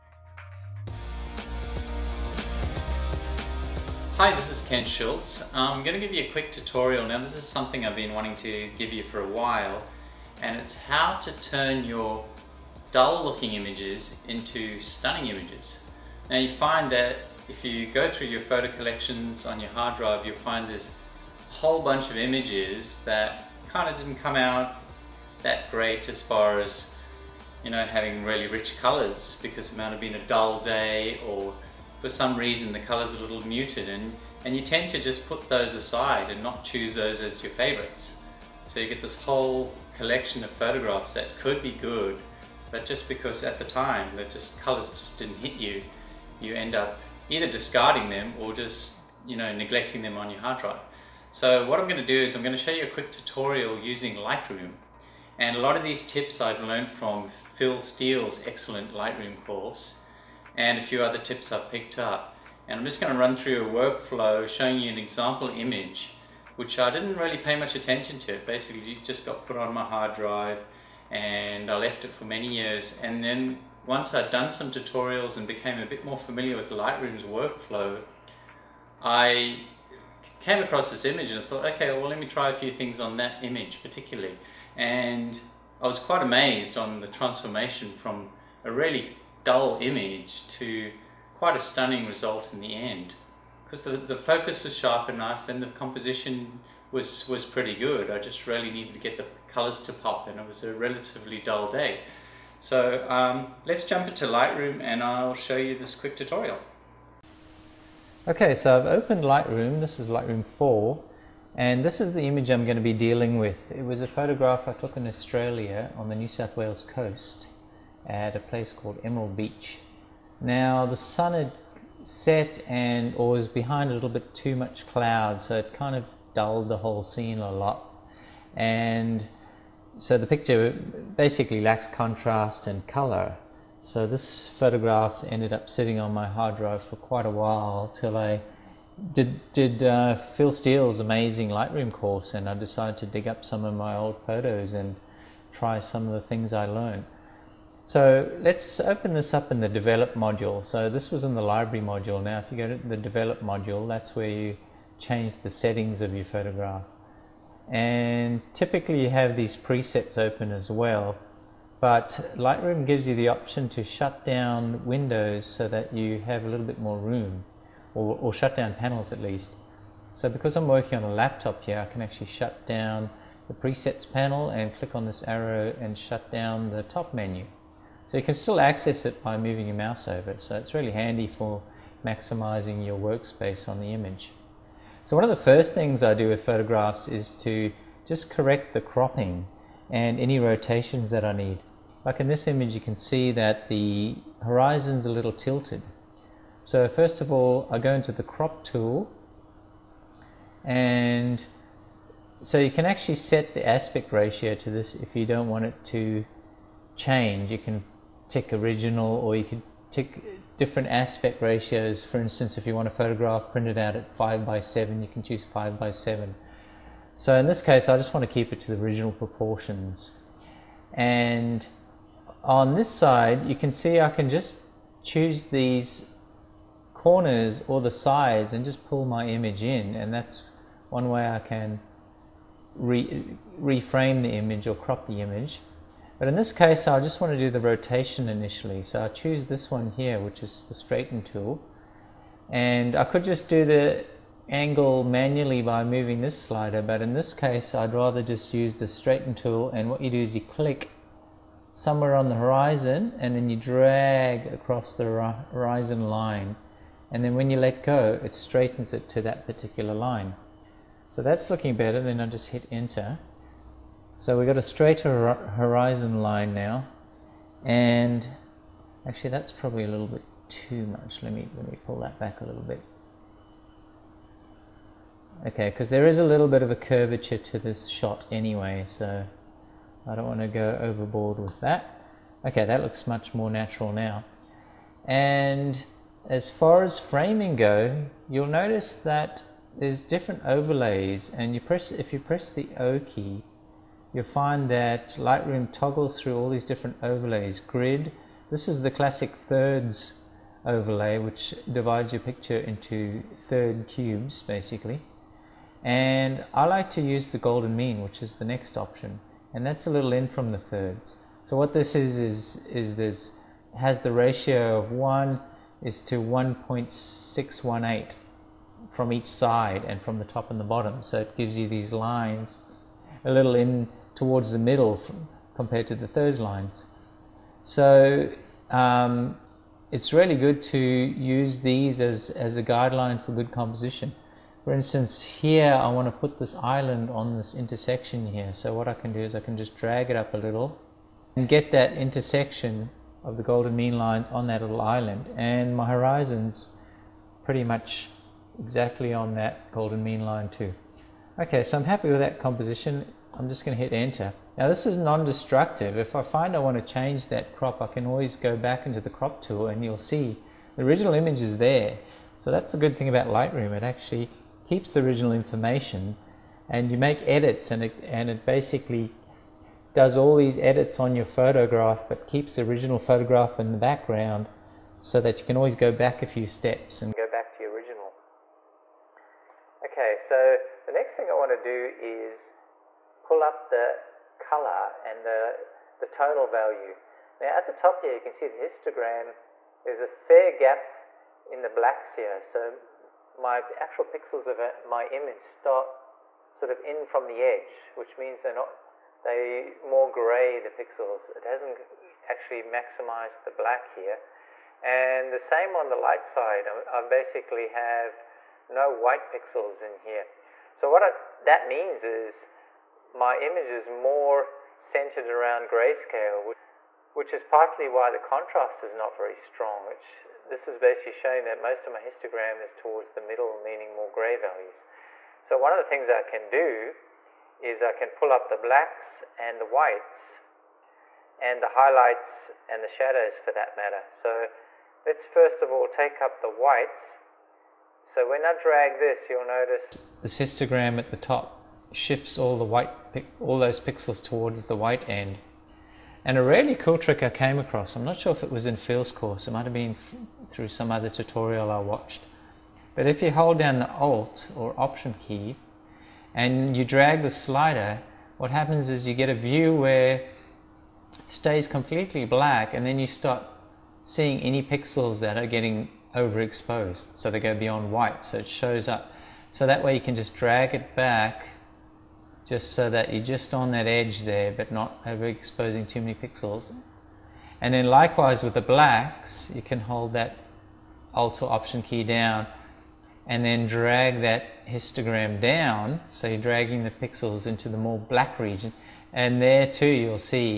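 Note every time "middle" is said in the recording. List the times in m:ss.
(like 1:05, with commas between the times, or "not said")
5:24, 7:03.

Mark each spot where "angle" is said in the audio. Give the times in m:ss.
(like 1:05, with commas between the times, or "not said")
4:04.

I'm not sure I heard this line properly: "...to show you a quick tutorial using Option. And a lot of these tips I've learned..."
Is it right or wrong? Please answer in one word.
wrong.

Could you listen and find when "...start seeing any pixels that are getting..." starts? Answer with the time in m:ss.
7:43.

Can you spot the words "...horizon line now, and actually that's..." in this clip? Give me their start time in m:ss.
4:25.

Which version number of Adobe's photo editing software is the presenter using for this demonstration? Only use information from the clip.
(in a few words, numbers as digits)
4.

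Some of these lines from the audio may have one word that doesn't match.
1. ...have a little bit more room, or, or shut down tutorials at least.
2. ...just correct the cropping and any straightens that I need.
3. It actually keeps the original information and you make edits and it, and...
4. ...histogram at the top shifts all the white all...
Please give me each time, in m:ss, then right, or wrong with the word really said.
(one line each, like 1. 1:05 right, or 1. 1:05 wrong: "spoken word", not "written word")
1. 2:46 wrong: "panels", not "tutorials"
2. 3:08 wrong: "rotations", not "straightens"
3. 6:03 right
4. 7:20 right.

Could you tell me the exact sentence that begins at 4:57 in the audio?
Grid, this is the classic thirds overlay which divides your picture into third cubes basically.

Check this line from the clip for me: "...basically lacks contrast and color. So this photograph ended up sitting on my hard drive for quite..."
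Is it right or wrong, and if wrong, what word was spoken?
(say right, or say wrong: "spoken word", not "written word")
right.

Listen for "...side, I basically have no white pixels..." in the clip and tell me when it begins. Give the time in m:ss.
6:46.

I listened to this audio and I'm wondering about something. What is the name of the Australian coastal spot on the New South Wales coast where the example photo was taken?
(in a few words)
Emerald Beach.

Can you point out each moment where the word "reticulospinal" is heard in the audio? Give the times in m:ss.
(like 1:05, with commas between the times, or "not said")
not said.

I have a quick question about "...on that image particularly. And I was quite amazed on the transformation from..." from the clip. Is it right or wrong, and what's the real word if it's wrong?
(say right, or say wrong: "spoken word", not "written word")
right.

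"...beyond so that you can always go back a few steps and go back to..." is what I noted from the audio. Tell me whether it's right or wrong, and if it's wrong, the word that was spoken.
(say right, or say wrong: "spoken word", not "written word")
wrong: "background", not "beyond".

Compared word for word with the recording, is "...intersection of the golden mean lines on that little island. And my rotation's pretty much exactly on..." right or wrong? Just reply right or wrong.
wrong.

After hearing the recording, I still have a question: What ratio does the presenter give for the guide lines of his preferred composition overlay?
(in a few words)
1 to 1.618.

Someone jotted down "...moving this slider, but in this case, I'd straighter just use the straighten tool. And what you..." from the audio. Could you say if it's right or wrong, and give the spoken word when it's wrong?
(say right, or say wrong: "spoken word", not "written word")
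wrong: "rather", not "straighter".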